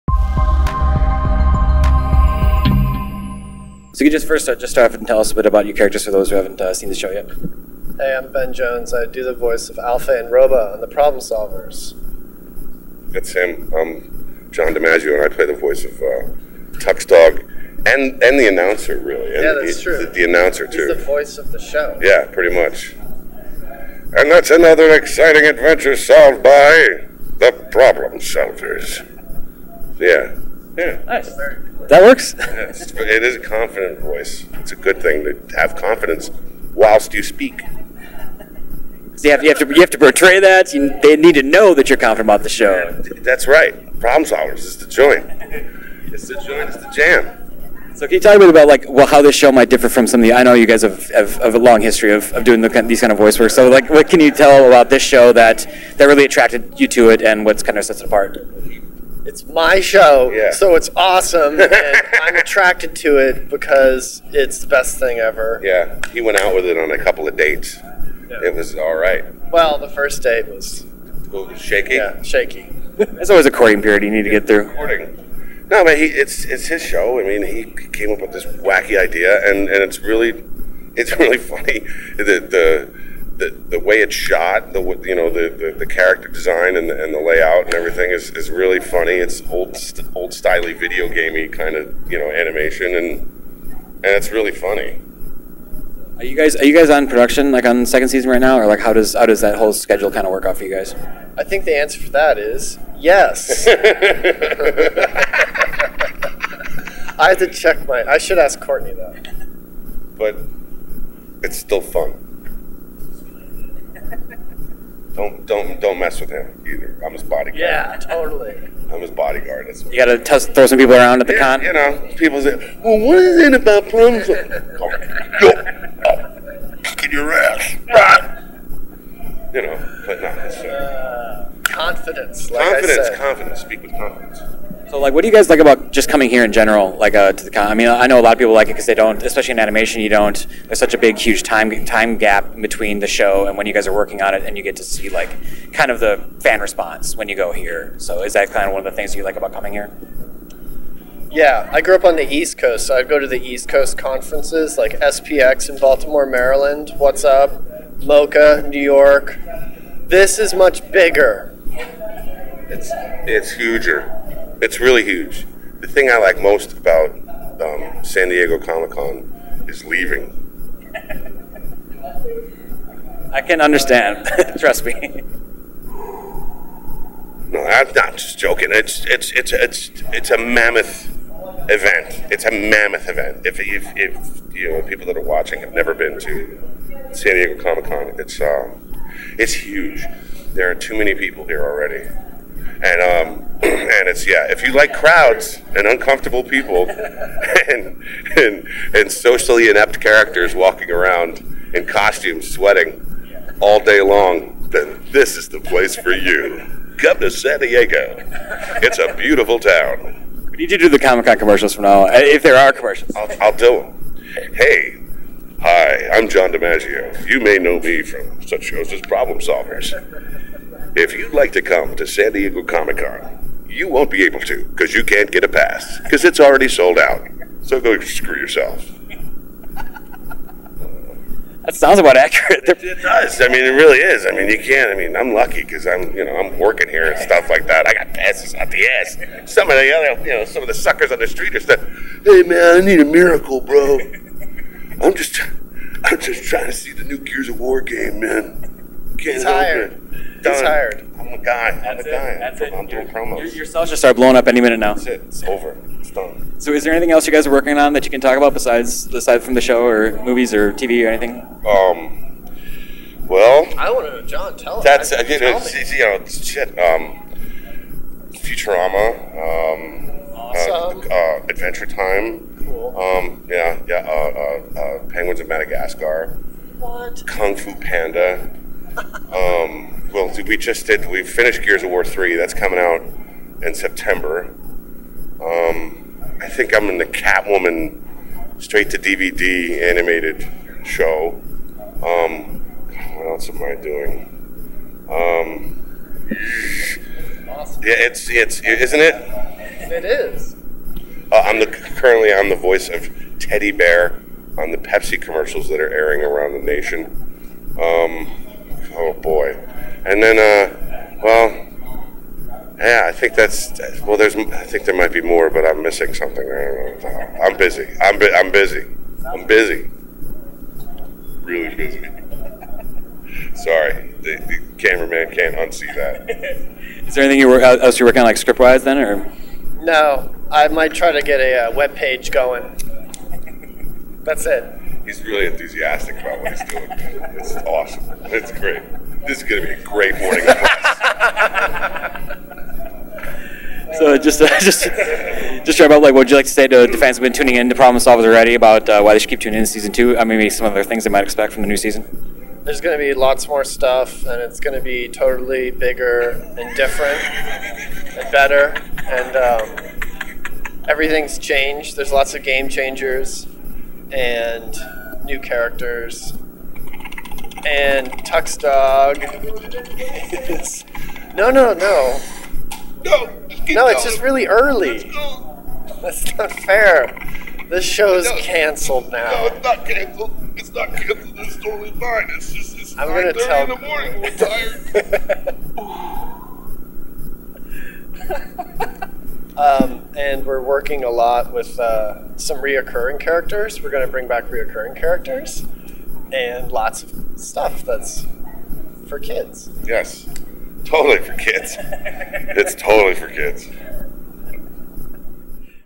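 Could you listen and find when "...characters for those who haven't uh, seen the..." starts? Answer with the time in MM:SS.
00:05.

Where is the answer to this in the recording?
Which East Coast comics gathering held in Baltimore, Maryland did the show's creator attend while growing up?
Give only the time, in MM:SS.
02:34.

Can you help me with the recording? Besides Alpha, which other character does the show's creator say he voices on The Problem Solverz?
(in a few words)
Roba.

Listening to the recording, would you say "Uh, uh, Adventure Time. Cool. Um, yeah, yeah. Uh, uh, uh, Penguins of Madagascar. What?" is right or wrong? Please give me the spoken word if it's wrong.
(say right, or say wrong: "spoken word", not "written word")
right.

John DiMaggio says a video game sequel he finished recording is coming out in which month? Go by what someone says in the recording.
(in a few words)
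September.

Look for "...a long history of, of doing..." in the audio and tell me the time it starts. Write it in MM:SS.
00:51.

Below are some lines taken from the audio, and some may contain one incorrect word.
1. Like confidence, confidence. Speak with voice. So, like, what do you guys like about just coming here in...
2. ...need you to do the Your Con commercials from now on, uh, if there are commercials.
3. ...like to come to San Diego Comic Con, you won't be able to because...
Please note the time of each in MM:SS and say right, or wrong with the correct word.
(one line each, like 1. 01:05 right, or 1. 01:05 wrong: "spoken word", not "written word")
1. 02:12 wrong: "confidence", not "voice"
2. 03:30 wrong: "Comic", not "Your"
3. 03:41 right.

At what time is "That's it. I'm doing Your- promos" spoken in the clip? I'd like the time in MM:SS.
04:12.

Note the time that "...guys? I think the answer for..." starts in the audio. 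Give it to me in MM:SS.
01:40.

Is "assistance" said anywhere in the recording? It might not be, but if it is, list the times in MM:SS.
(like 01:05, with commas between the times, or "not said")
not said.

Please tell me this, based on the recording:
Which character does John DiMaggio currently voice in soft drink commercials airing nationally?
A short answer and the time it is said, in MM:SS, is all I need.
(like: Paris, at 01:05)
Teddy Bear, at 05:03.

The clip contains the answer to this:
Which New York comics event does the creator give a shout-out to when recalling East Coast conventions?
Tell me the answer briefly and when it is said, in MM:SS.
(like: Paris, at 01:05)
MoCCA, at 02:38.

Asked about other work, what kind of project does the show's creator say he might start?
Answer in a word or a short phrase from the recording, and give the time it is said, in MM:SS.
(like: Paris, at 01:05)
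web page, at 05:31.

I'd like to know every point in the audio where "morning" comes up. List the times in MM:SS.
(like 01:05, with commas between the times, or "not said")
05:40, 06:23.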